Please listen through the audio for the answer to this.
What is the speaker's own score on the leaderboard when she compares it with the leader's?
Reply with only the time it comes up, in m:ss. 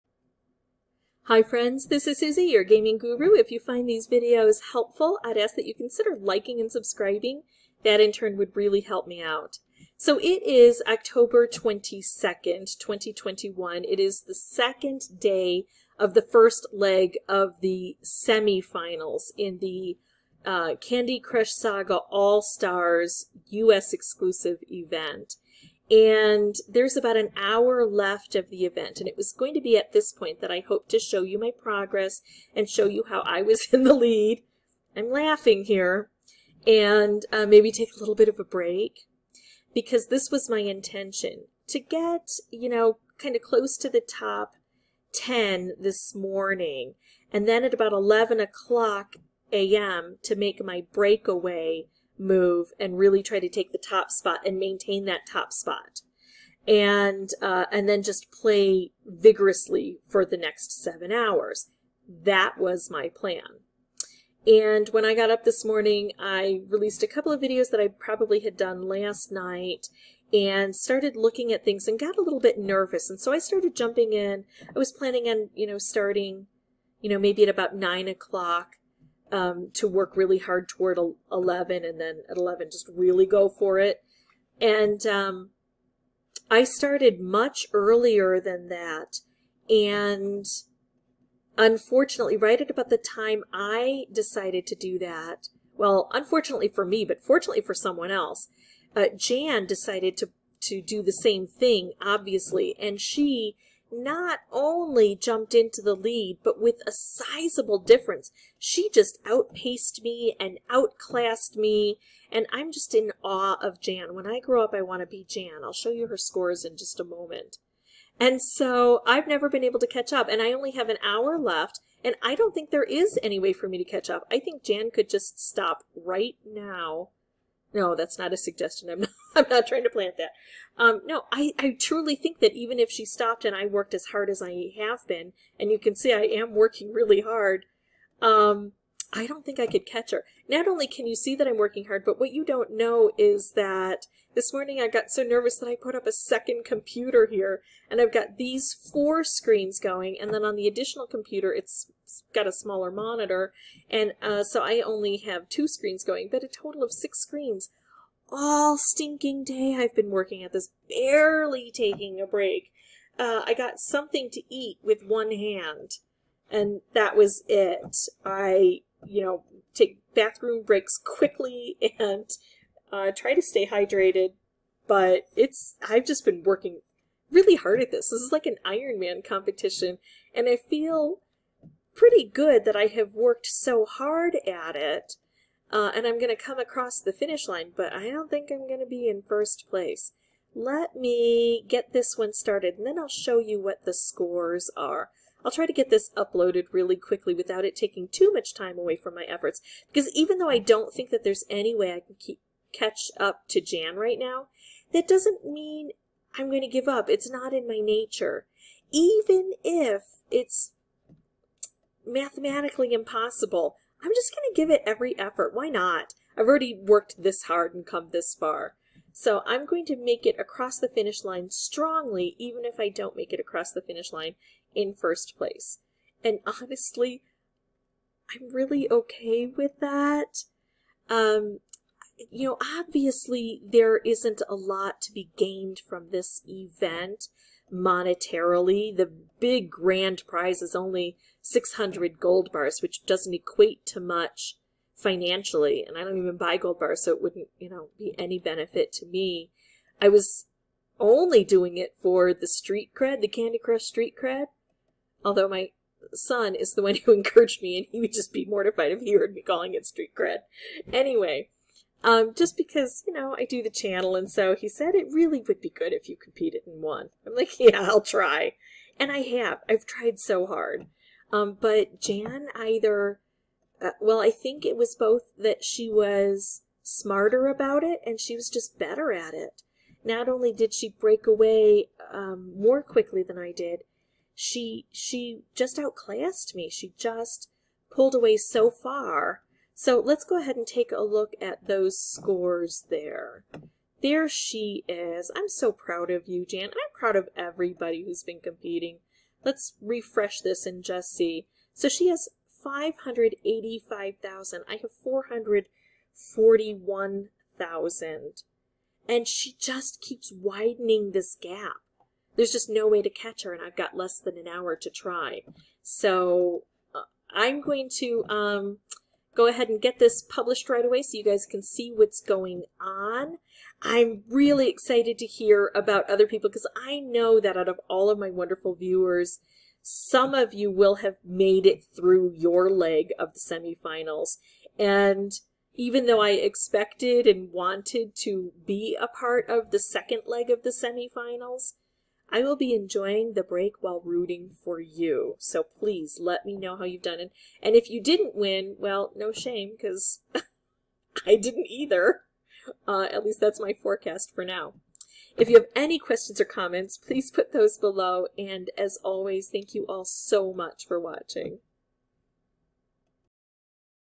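5:05.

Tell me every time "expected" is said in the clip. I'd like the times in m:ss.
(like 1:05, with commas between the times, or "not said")
5:36.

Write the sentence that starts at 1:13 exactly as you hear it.
And so I started jumping in.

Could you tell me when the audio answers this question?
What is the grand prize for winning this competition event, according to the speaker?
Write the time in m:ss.
4:01.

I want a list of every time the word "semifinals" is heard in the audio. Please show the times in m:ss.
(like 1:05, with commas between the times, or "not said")
0:18, 5:33, 5:40.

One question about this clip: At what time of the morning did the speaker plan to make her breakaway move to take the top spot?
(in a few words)
11 a.m.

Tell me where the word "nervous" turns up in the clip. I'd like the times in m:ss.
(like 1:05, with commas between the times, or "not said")
1:12, 2:25.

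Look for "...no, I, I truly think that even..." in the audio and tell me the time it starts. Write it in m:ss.
2:11.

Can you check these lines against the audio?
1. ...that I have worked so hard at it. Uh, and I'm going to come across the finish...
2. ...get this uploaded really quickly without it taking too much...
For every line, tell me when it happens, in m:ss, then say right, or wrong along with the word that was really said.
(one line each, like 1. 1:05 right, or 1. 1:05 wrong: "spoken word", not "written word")
1. 3:02 right
2. 3:15 right.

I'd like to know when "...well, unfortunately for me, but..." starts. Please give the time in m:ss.
1:35.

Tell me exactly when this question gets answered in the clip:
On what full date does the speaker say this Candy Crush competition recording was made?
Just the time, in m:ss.
0:10.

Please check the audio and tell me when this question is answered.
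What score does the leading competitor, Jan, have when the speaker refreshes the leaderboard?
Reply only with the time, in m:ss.
5:02.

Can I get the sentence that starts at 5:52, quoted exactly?
Uh, at least that's my forecast for now.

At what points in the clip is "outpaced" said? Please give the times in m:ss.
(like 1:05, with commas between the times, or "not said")
1:49.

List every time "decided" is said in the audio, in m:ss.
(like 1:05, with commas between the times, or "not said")
1:34, 1:39.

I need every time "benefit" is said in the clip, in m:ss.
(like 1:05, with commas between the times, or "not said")
4:08.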